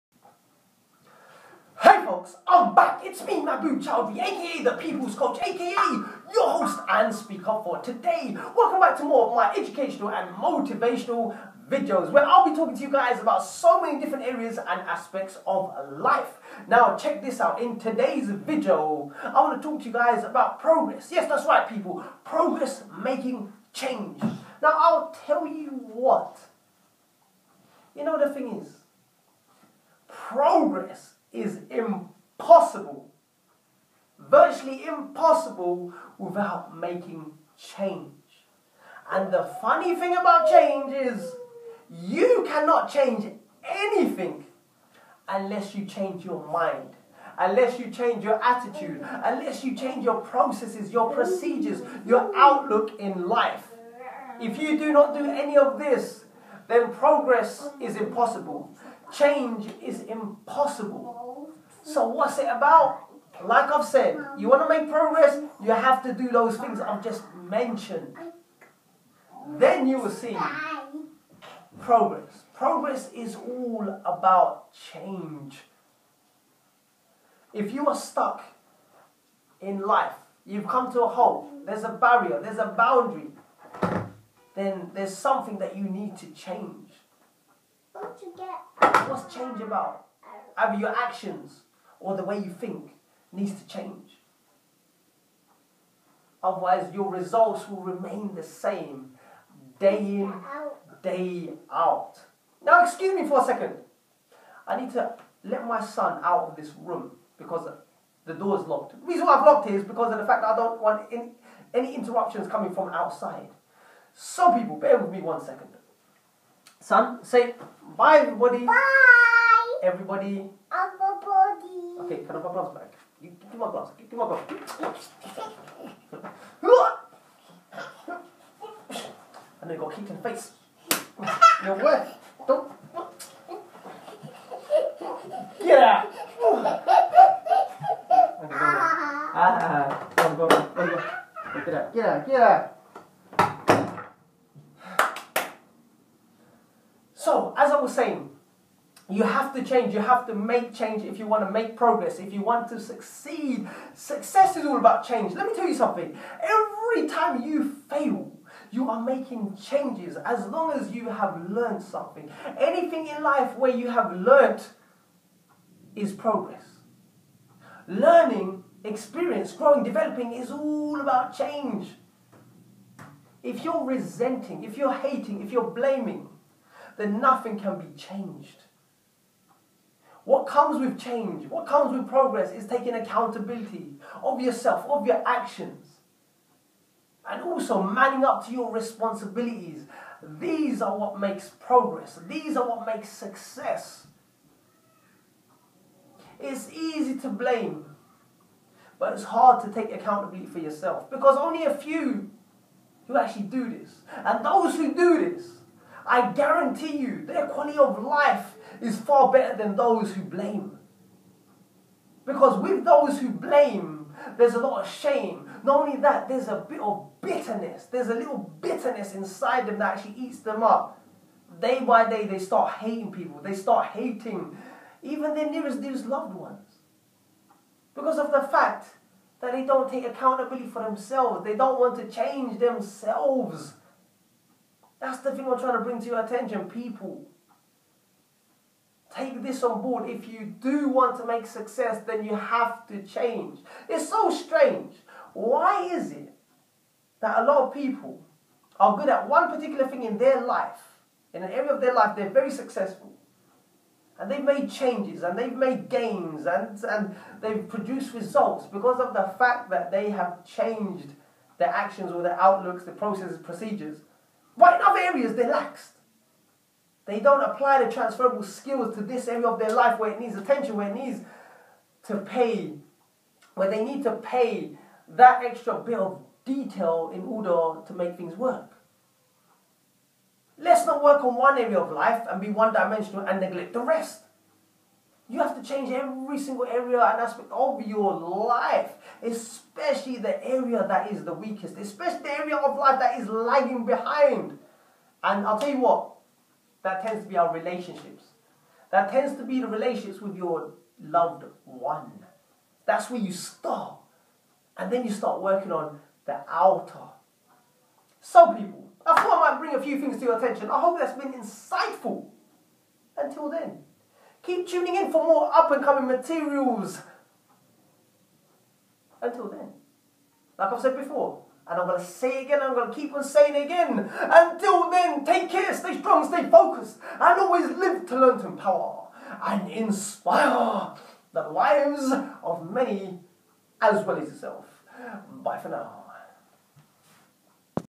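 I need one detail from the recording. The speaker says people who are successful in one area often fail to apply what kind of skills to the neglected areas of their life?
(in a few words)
Transferable skills.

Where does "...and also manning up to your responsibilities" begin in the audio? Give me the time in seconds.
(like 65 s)
187 s.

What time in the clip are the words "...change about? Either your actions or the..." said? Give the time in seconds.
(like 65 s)
89 s.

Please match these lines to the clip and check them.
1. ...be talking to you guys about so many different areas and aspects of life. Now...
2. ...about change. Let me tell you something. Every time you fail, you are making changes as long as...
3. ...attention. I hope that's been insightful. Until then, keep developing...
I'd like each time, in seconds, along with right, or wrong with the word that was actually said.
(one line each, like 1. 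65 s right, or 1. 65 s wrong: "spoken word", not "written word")
1. 12 s right
2. 154 s right
3. 310 s wrong: "tuning", not "developing".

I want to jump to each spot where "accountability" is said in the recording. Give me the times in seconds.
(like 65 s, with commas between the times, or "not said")
182 s, 199 s, 230 s.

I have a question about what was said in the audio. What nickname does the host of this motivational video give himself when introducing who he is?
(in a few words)
The People's Coach.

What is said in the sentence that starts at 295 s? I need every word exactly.
And I'll tell you what, that tends to be our relationships.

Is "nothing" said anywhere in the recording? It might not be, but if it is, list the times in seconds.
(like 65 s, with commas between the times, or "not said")
177 s.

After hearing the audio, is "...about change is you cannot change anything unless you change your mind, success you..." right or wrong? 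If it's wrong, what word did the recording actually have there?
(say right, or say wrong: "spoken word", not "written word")
wrong: "unless", not "success".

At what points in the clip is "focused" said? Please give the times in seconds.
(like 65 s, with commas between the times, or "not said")
326 s.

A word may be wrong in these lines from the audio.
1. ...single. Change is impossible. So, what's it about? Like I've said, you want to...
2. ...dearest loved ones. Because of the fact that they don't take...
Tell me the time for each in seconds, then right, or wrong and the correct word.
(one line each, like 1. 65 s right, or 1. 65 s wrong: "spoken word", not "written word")
1. 57 s wrong: "impossible", not "single"
2. 225 s right.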